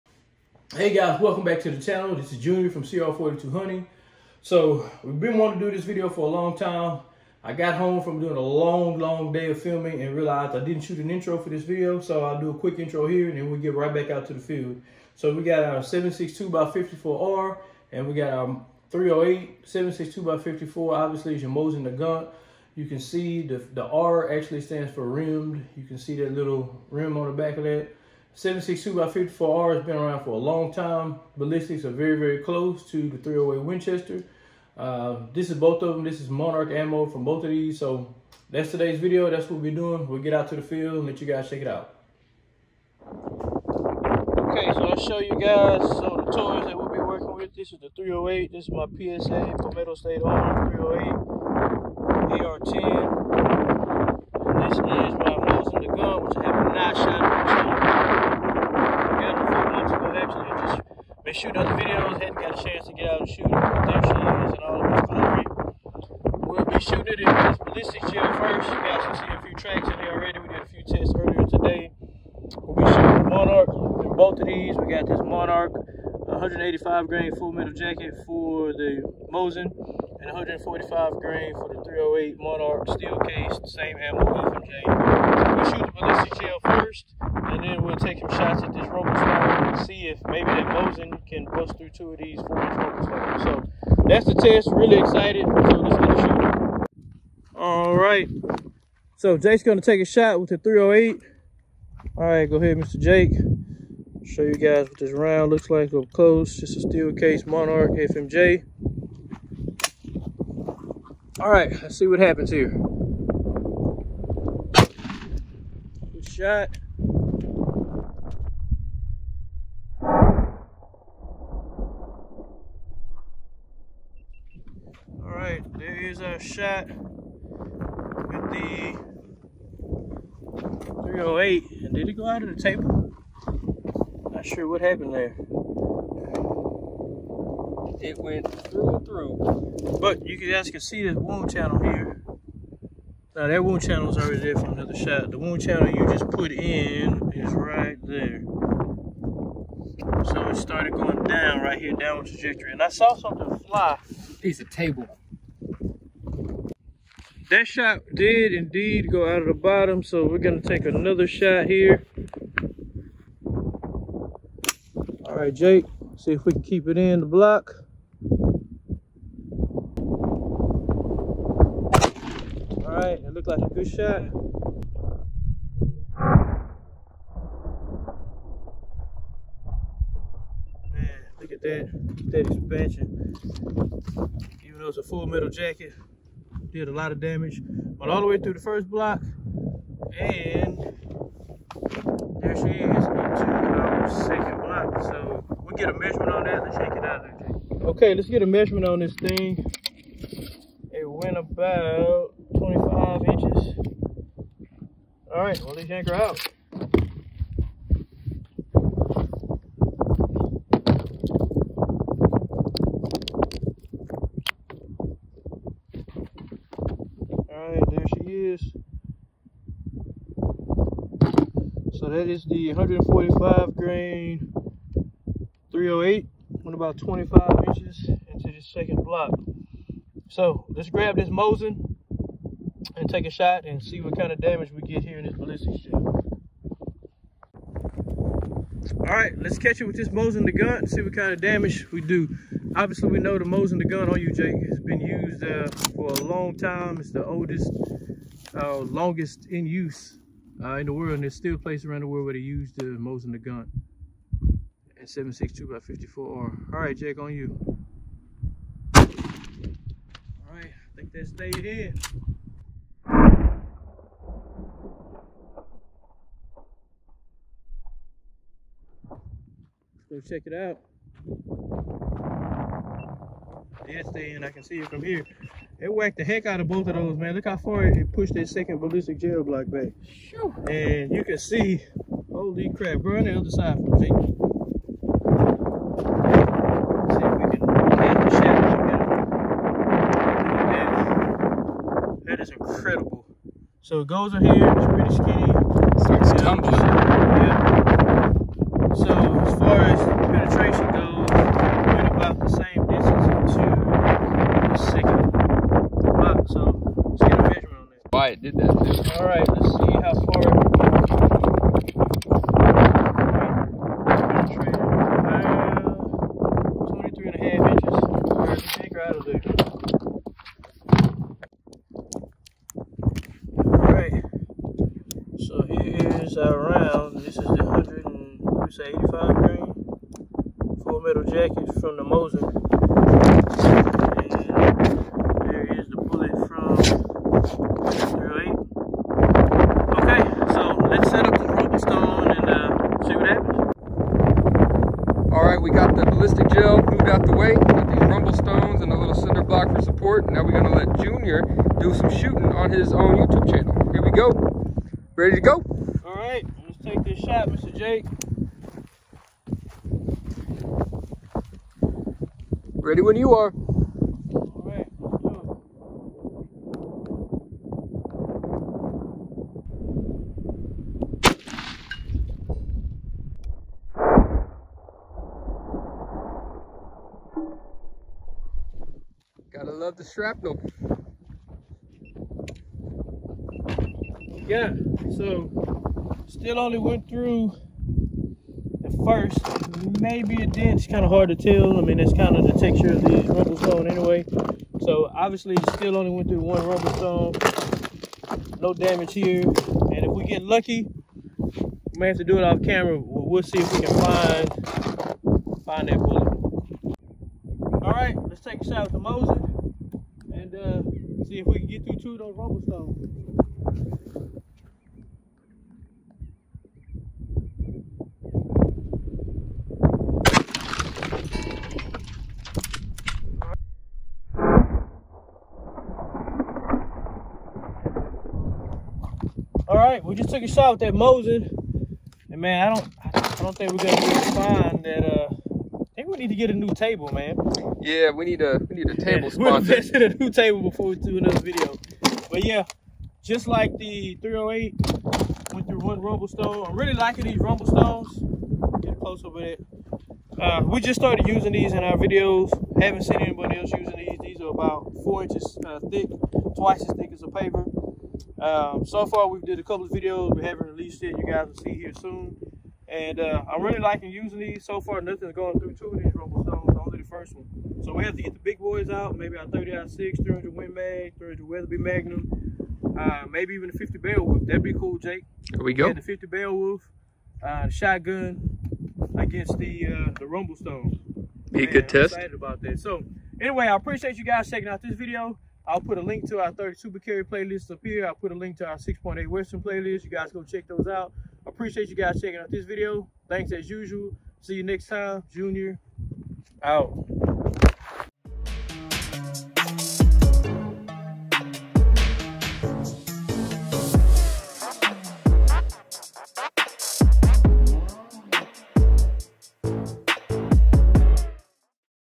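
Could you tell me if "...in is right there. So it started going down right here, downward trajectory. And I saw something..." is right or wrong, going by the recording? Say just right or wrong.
right.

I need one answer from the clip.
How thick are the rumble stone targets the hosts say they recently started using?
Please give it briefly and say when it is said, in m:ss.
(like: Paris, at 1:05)
4 inches, at 7:35.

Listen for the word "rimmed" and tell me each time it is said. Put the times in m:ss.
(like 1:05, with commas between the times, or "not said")
0:25.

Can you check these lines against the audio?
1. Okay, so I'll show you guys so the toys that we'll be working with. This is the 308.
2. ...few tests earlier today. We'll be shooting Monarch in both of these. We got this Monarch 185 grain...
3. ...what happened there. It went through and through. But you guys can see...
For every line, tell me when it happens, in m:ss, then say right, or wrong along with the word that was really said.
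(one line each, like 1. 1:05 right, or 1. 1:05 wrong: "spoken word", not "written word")
1. 0:43 right
2. 1:10 right
3. 2:14 right.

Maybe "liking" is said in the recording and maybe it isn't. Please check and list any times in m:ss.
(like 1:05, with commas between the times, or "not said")
7:26, 7:43.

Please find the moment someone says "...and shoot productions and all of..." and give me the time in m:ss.
1:03.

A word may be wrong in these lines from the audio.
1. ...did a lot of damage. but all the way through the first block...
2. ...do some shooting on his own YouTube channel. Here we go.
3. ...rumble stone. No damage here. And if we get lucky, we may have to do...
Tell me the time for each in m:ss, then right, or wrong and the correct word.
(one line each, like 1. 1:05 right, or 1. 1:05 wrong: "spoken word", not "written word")
1. 3:06 right
2. 5:51 right
3. 6:36 right.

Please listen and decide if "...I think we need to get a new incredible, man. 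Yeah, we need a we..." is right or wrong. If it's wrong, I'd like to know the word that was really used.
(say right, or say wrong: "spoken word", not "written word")
wrong: "table", not "incredible".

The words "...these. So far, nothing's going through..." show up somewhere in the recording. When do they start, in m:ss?
7:44.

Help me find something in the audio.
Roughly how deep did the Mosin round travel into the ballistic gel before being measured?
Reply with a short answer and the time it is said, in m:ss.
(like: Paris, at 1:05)
23.5 inches, at 5:16.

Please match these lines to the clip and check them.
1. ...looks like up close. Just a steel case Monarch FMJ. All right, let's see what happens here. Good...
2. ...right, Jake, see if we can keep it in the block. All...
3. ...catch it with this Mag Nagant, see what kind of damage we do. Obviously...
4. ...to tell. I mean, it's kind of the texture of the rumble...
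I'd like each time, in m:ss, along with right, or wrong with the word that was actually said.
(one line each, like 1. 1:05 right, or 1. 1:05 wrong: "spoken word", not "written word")
1. 1:45 right
2. 2:45 right
3. 3:59 wrong: "Mosin", not "Mag"
4. 6:31 right.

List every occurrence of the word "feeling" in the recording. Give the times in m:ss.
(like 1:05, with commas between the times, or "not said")
not said.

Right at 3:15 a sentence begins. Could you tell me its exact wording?
So we'll get a measurement on that.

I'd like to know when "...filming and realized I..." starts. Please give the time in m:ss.
0:09.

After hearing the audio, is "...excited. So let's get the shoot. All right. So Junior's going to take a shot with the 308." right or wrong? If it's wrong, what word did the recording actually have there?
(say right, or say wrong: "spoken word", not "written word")
wrong: "Jake", not "Junior".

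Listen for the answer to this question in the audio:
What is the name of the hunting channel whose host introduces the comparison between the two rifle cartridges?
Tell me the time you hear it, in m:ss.
0:02.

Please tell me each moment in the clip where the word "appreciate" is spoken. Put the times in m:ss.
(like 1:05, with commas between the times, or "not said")
8:03, 8:11.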